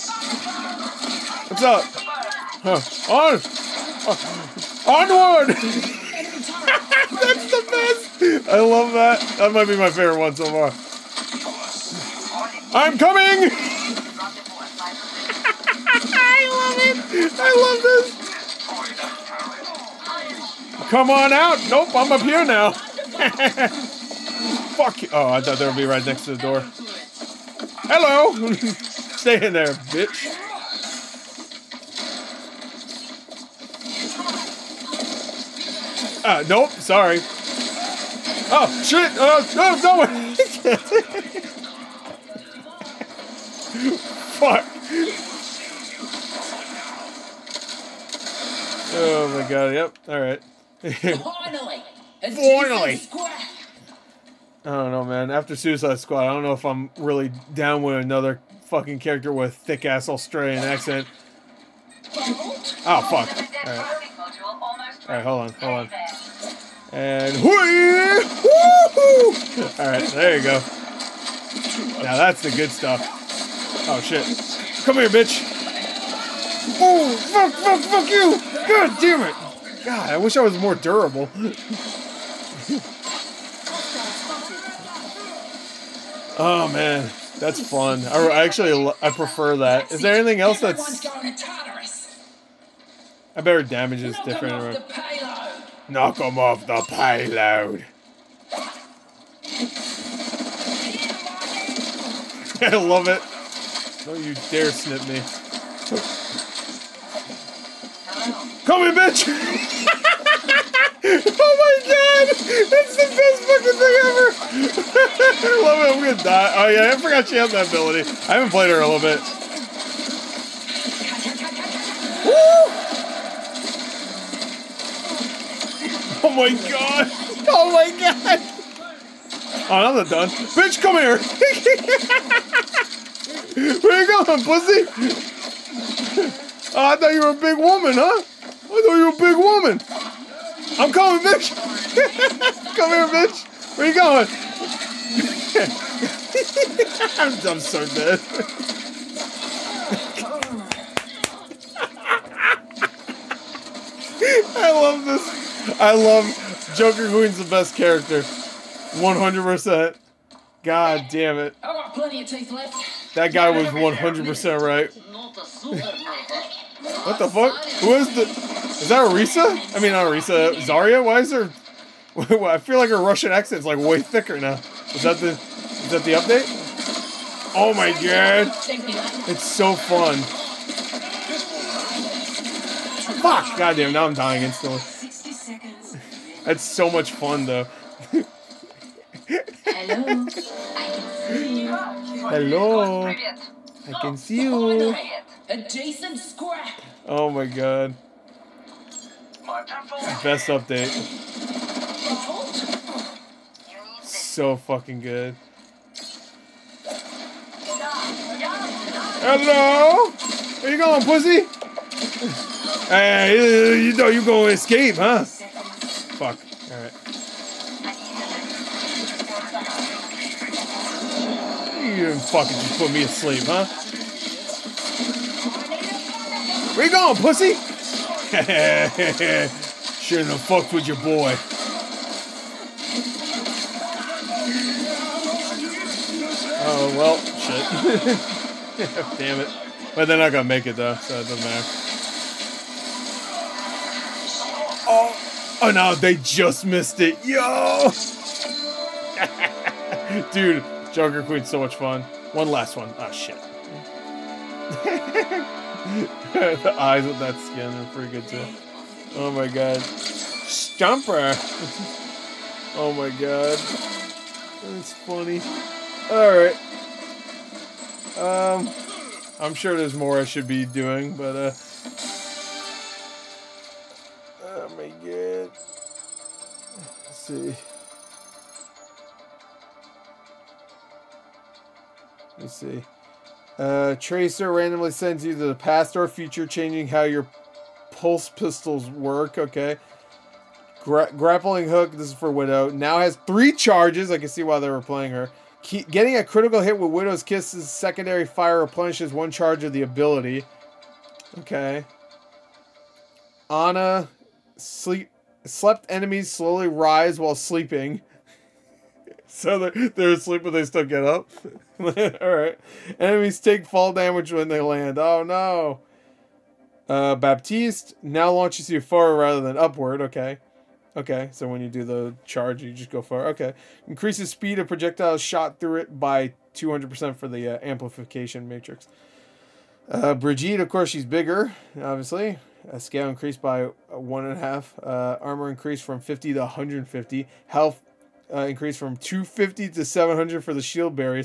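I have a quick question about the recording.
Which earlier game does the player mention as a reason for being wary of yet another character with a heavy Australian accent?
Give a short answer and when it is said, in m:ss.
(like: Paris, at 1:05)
Suicide Squad, at 0:55.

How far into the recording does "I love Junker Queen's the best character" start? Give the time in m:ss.
2:35.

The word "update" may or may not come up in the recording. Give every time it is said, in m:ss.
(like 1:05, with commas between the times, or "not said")
2:56, 3:20.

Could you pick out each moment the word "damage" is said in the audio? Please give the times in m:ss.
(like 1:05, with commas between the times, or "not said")
1:33, 5:13.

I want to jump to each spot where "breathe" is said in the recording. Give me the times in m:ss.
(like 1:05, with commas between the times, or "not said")
not said.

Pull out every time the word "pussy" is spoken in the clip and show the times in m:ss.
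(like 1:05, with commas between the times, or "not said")
2:14, 3:31, 3:47.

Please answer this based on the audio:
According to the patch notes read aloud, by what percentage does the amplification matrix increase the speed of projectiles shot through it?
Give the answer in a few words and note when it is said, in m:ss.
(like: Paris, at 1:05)
200%, at 5:26.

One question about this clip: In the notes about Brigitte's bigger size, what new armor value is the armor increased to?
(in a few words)
150.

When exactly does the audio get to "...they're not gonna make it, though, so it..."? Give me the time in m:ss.
4:00.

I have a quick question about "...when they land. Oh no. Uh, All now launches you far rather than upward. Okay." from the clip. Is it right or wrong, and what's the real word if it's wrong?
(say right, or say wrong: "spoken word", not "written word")
wrong: "Baptiste", not "All".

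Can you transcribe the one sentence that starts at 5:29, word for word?
Uh, Brigitte, of course, she's bigger, obviously.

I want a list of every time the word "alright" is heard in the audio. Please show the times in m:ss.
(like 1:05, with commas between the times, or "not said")
0:50, 1:03, 1:09, 3:36, 4:26.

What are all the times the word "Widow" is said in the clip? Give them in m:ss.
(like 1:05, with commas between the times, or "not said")
4:52, 4:56.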